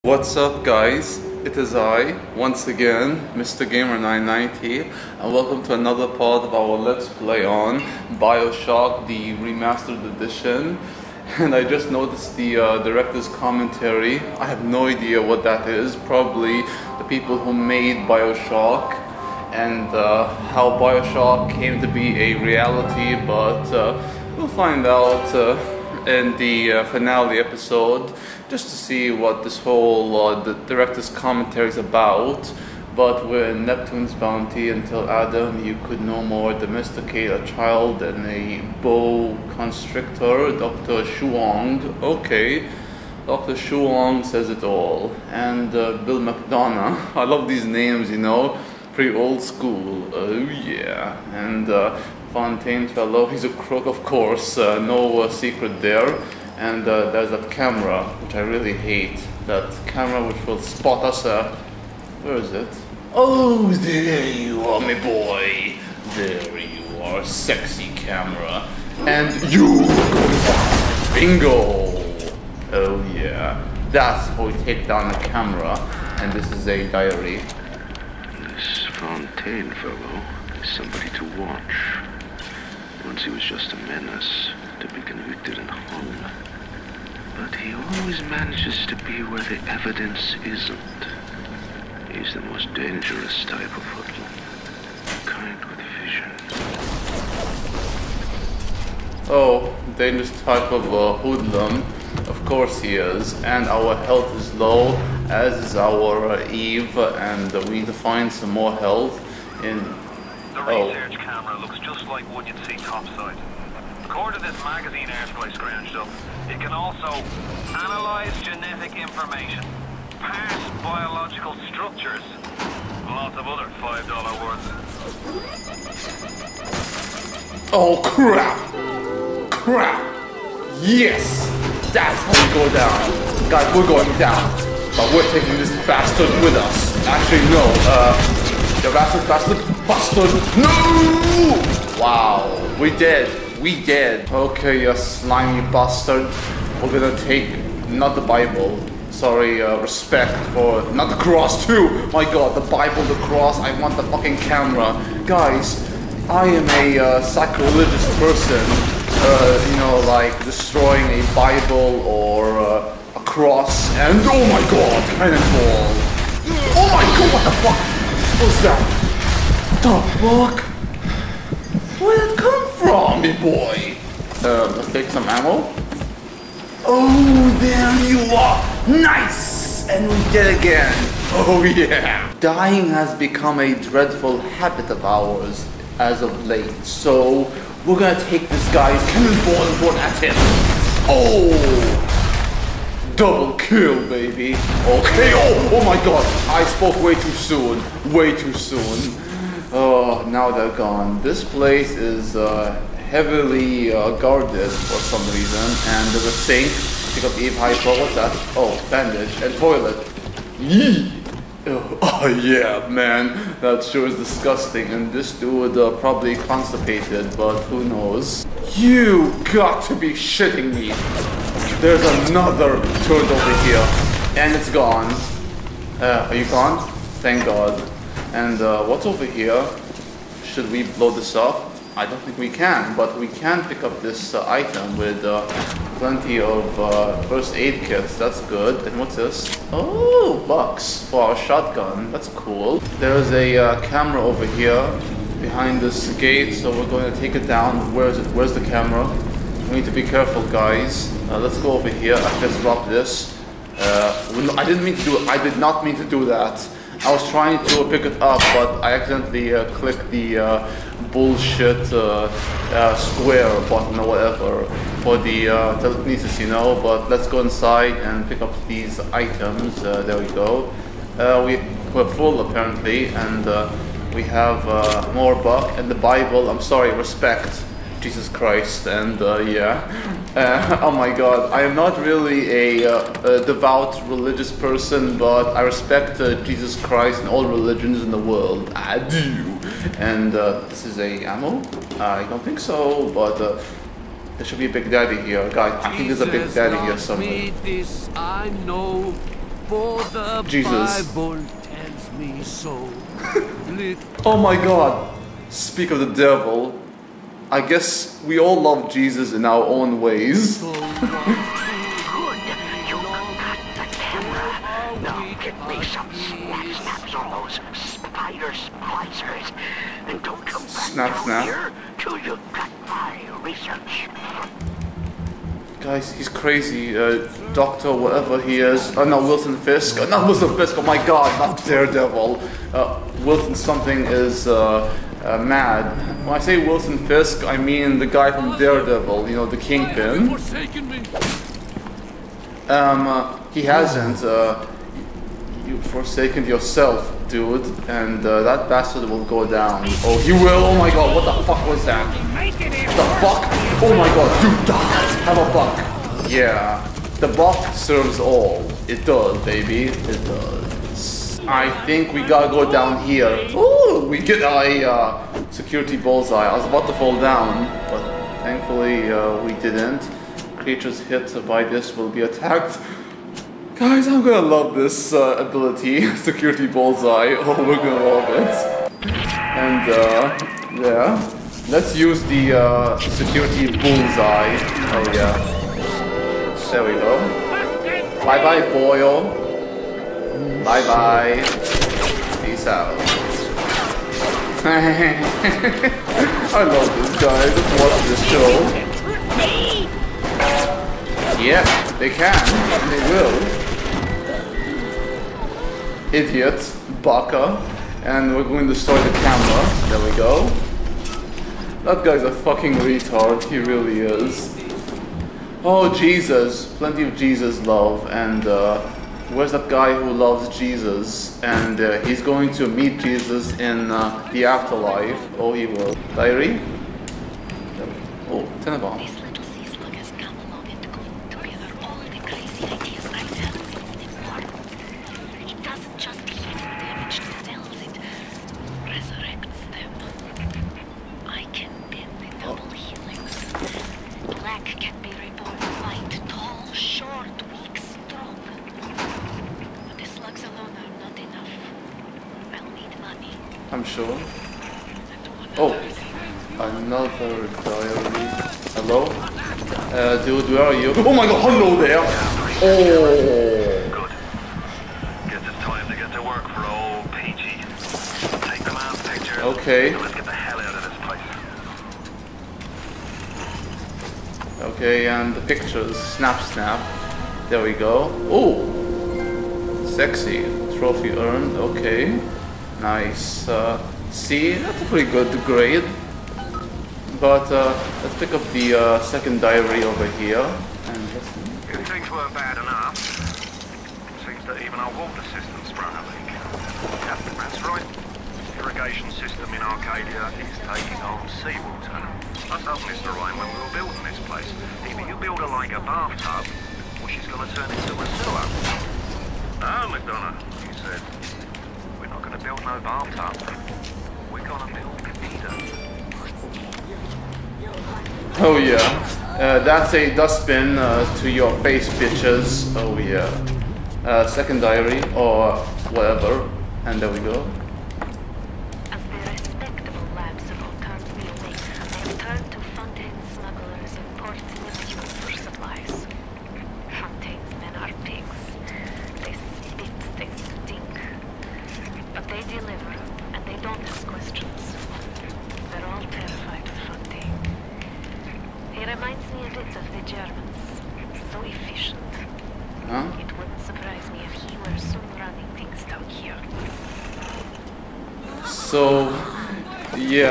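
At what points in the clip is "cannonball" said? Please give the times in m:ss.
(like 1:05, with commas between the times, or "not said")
2:45, 3:09.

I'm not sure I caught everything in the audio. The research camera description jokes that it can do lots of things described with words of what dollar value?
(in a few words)
$5.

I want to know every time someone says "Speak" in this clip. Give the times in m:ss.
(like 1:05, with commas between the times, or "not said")
5:05.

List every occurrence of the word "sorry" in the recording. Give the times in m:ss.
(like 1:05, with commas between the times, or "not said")
2:29, 4:36.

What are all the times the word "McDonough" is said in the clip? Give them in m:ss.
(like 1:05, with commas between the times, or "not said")
0:46, 8:29.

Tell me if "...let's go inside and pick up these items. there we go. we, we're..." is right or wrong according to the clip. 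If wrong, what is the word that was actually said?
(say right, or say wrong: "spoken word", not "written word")
right.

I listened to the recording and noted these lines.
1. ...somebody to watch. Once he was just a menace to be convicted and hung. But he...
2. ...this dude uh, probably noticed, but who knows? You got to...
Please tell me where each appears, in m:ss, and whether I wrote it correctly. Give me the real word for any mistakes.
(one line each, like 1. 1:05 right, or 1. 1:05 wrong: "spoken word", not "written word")
1. 1:20 right
2. 3:35 wrong: "constipated", not "noticed".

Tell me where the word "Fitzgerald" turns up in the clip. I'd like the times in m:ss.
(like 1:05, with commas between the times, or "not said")
not said.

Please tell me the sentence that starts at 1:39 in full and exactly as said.
Oh, dangerous type of uh, hoodlum.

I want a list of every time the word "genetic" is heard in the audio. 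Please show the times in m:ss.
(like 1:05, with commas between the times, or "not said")
1:58.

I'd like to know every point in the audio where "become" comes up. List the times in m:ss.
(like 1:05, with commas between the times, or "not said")
3:03.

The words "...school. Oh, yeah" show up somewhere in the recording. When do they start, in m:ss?
0:49.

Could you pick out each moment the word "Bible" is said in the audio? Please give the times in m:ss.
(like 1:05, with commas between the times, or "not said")
2:28, 2:32, 2:41, 4:35, 5:01.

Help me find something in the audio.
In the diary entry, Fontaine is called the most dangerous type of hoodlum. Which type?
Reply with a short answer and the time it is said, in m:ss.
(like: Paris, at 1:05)
Kind with vision, at 1:35.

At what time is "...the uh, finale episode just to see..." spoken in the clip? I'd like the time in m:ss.
0:26.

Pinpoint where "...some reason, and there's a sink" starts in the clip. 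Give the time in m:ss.
3:24.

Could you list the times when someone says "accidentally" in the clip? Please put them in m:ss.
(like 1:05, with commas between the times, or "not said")
4:18.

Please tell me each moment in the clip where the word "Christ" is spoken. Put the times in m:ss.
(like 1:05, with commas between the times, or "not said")
4:38, 4:46.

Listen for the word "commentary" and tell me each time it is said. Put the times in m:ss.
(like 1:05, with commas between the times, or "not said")
0:13, 0:31.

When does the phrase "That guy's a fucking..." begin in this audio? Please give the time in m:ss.
6:51.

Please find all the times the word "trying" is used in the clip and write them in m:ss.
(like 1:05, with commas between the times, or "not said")
4:17.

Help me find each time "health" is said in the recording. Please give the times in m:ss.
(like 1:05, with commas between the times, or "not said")
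1:44, 1:48.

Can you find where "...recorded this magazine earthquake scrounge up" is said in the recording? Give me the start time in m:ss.
1:54.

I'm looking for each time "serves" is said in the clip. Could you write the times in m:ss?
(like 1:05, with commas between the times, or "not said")
5:57.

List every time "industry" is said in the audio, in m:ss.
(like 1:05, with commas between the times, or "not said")
not said.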